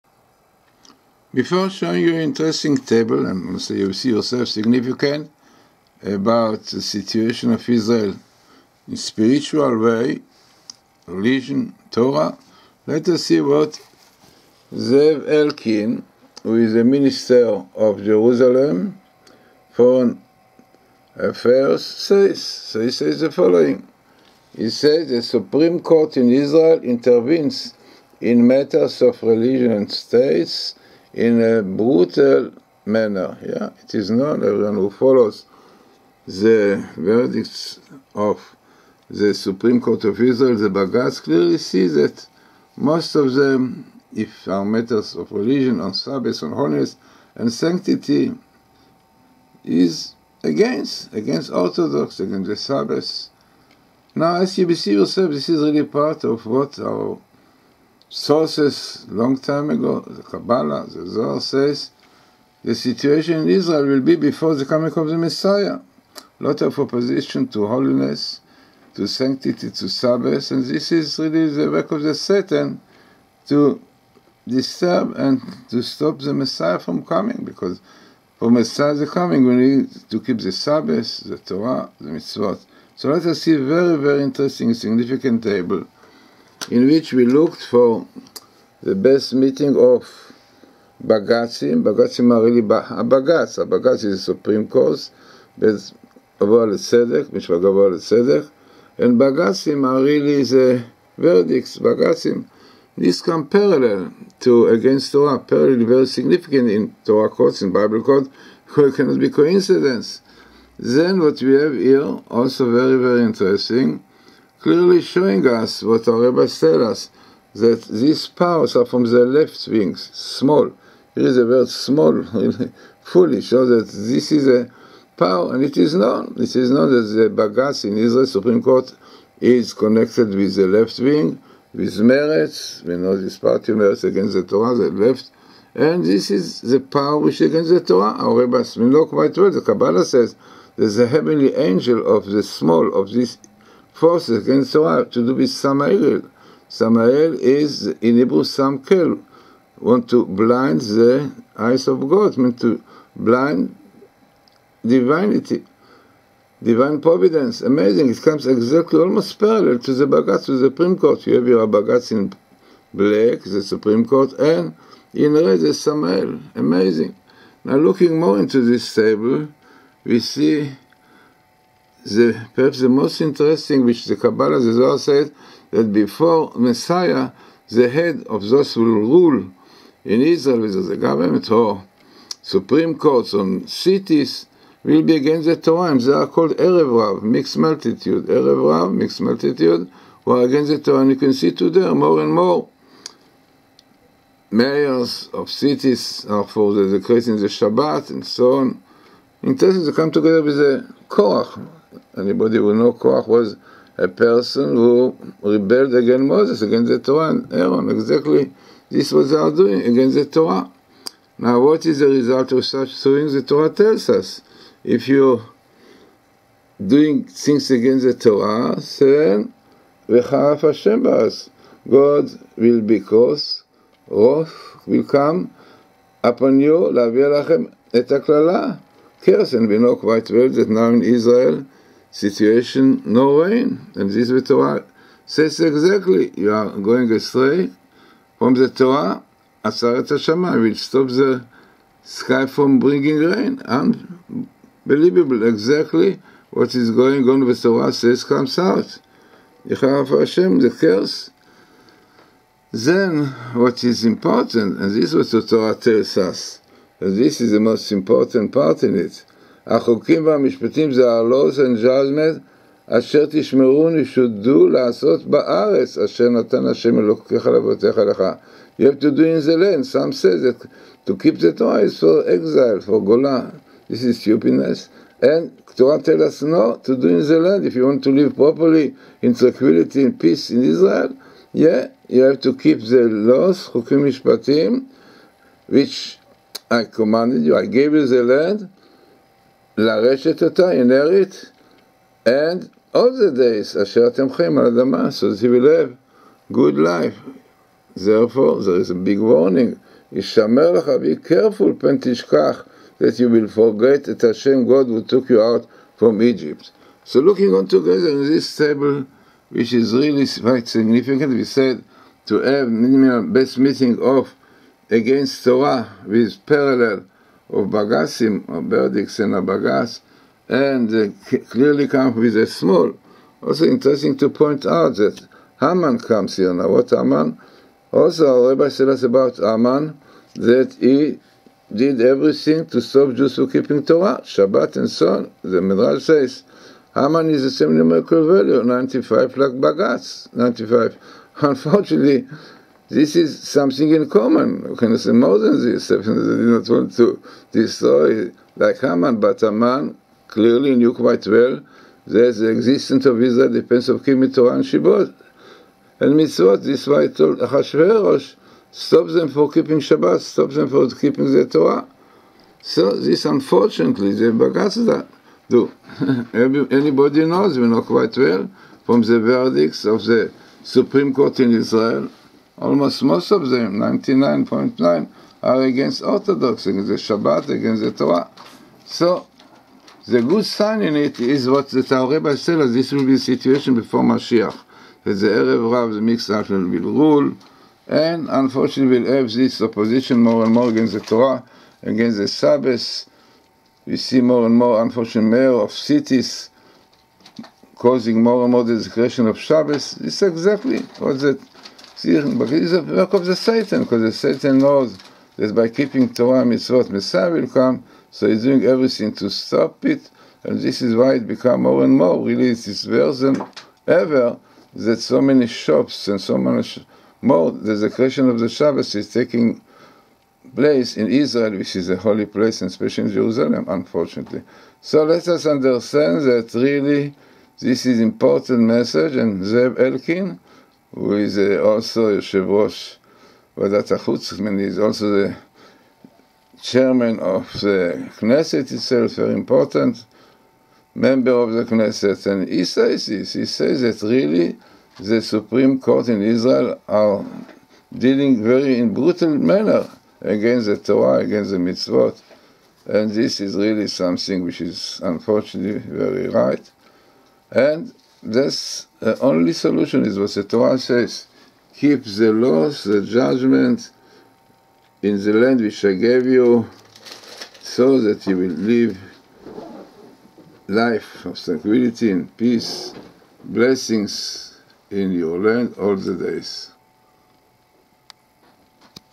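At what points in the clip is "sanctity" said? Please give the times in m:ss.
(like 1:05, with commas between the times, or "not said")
0:47, 1:09.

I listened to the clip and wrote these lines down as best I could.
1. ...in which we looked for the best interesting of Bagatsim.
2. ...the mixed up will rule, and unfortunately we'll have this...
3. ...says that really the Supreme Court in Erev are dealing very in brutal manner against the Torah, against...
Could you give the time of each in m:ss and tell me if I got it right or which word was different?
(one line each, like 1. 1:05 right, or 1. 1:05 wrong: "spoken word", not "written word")
1. 1:26 wrong: "meeting", not "interesting"
2. 6:25 right
3. 7:23 wrong: "Israel", not "Erev".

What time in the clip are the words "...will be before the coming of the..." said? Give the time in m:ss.
1:03.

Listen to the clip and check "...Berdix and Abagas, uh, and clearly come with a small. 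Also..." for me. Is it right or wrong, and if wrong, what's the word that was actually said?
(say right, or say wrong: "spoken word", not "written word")
right.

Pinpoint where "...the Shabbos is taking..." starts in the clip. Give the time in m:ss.
6:58.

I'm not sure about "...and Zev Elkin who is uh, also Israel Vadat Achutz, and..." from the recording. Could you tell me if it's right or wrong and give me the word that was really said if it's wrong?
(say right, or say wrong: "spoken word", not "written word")
wrong: "Yeshevosh", not "Israel".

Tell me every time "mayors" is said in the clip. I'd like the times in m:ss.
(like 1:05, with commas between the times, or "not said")
3:14, 6:35.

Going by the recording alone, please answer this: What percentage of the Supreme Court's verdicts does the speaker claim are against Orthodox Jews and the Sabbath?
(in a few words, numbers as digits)
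99.9.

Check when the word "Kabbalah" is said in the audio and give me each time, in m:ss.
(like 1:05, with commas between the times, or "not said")
1:00, 2:19, 2:54.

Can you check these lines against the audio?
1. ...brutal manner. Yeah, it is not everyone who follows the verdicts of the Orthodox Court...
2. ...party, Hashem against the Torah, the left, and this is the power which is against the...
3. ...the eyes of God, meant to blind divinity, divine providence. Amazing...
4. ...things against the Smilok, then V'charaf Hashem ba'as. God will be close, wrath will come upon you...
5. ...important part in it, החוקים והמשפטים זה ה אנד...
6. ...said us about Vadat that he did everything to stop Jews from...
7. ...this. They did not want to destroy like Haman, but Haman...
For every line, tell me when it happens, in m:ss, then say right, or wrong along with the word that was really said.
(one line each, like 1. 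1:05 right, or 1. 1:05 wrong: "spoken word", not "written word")
1. 0:31 wrong: "Supreme", not "Orthodox"
2. 2:13 wrong: "Meretz", not "Hashem"
3. 2:30 right
4. 3:37 wrong: "Torah", not "Smilok"
5. 4:17 right
6. 5:28 wrong: "Haman", not "Vadat"
7. 5:45 right.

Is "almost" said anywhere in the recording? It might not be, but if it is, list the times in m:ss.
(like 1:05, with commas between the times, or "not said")
2:38, 6:12.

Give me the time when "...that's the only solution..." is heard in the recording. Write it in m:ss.
7:38.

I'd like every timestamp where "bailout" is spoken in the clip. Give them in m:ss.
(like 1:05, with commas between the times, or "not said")
not said.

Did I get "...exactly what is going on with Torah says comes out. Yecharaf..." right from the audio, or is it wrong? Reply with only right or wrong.
right.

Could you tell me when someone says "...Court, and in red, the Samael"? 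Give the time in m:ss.
2:44.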